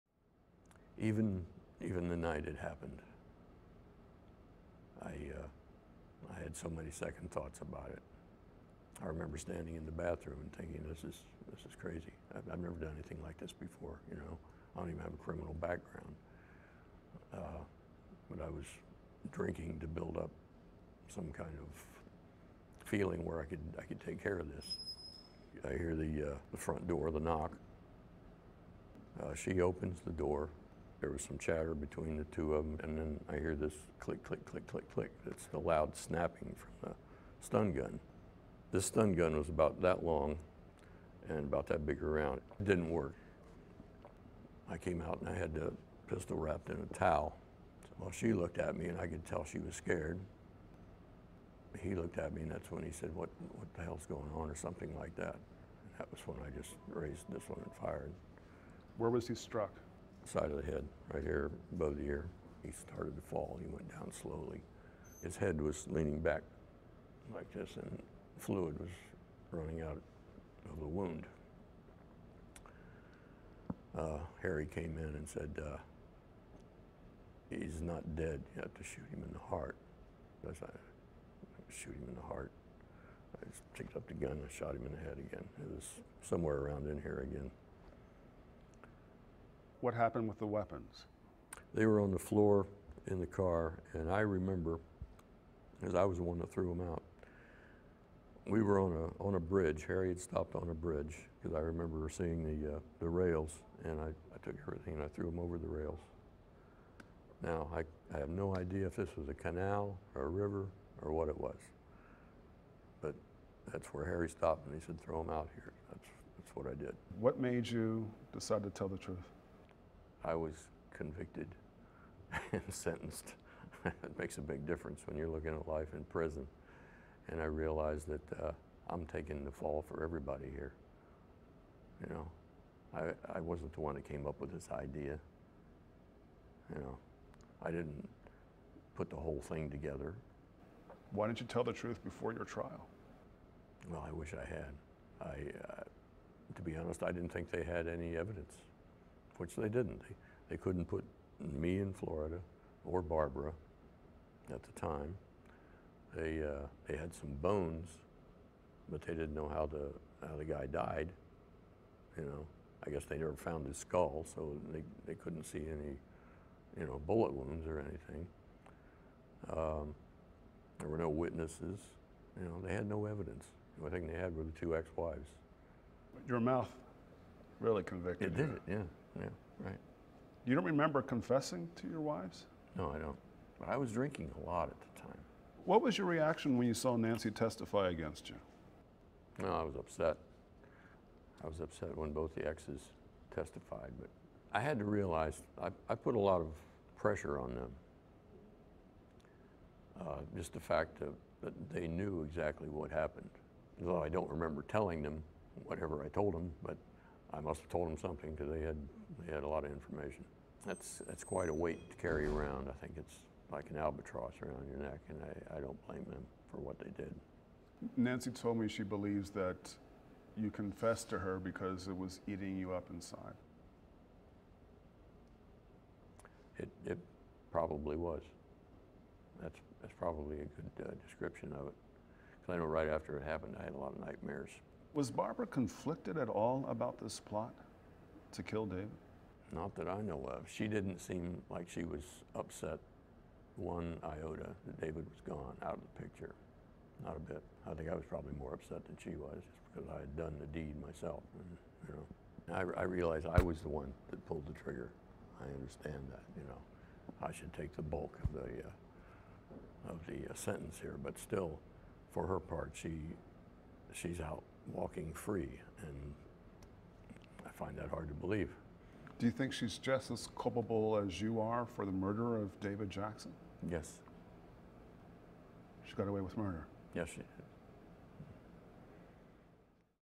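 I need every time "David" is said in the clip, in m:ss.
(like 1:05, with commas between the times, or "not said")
3:58, 4:04, 4:32.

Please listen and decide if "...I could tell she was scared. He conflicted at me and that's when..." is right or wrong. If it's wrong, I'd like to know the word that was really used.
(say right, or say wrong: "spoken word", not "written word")
wrong: "looked", not "conflicted".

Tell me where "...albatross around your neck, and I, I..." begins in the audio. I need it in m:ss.
3:33.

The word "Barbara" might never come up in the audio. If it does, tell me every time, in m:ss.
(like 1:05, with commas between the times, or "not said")
2:33, 3:55.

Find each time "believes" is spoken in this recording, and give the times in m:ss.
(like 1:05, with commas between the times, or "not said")
3:38, 4:28.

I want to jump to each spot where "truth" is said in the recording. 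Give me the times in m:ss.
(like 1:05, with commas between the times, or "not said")
1:58, 2:21.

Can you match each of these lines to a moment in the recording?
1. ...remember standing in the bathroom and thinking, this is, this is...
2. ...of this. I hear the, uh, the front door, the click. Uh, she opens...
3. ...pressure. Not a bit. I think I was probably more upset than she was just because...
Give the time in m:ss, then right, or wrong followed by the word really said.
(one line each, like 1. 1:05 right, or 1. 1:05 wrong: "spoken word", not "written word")
1. 0:09 right
2. 0:24 wrong: "knock", not "click"
3. 4:06 wrong: "picture", not "pressure".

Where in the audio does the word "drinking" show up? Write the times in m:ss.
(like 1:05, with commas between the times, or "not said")
0:19, 3:03.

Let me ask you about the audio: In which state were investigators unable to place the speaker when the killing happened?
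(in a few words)
Florida.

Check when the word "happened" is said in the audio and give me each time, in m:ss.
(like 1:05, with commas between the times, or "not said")
0:02, 1:29, 3:22, 3:53.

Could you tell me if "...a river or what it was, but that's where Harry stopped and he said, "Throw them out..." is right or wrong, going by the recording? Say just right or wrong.
right.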